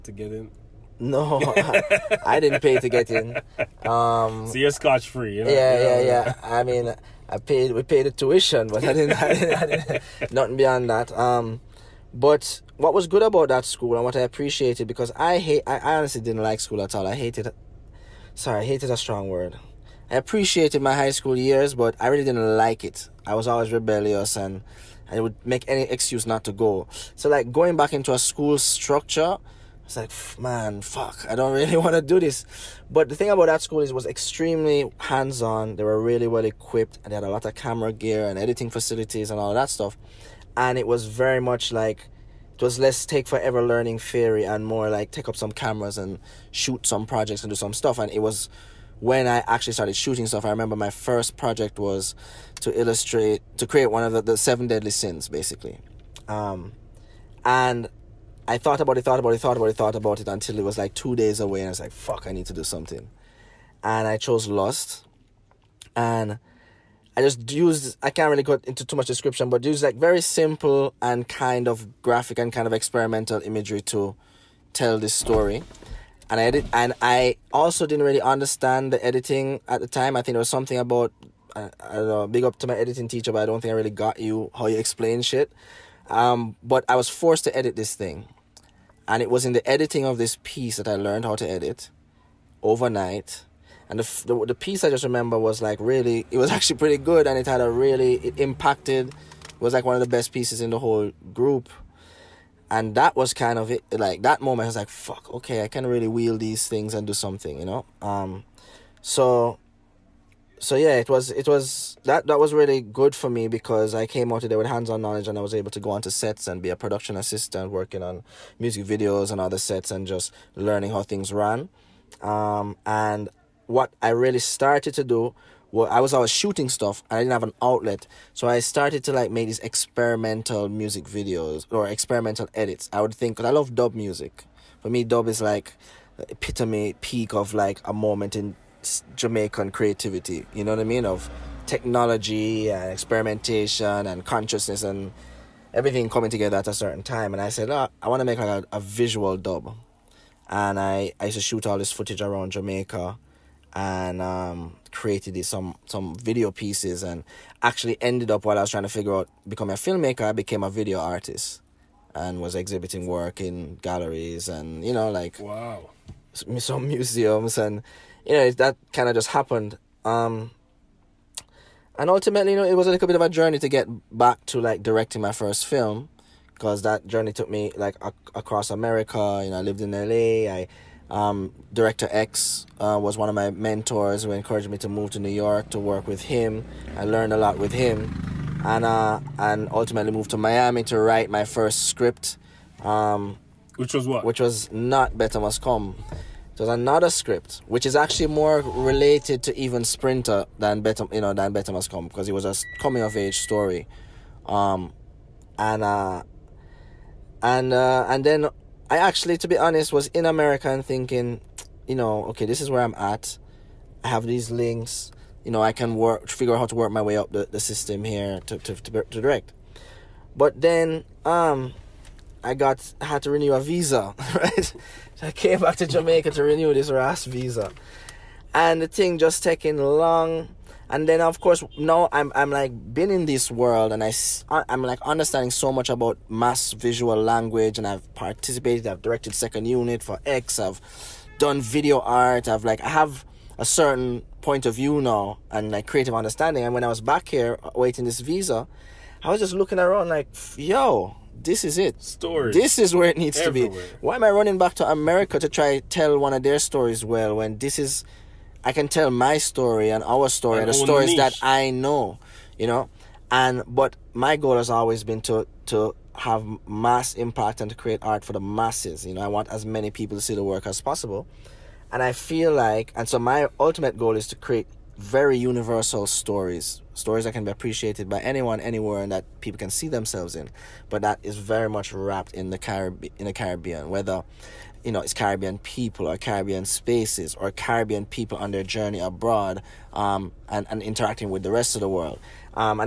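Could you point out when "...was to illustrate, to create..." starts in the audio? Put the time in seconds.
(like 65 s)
51 s.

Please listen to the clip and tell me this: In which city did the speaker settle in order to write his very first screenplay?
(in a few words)
Miami.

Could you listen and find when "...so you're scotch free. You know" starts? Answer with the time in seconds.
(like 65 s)
4 s.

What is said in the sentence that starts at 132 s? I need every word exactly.
I would think, because I love dub music.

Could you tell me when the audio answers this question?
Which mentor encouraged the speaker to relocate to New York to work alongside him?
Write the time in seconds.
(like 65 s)
181 s.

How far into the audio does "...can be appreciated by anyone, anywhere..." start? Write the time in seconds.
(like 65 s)
277 s.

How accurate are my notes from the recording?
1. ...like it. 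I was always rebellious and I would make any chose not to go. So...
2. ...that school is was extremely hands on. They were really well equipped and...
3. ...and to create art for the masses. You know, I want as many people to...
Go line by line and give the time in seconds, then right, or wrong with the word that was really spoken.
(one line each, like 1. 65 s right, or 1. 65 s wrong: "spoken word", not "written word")
1. 22 s wrong: "excuse", not "chose"
2. 33 s right
3. 267 s right.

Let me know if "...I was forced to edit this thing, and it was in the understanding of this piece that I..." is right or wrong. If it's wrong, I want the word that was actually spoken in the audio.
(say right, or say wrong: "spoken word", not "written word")
wrong: "editing", not "understanding".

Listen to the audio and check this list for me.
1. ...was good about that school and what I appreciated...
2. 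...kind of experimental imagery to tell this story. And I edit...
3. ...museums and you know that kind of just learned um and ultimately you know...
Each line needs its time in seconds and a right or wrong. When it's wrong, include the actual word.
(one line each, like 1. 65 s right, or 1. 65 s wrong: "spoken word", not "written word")
1. 12 s right
2. 72 s right
3. 166 s wrong: "happened", not "learned".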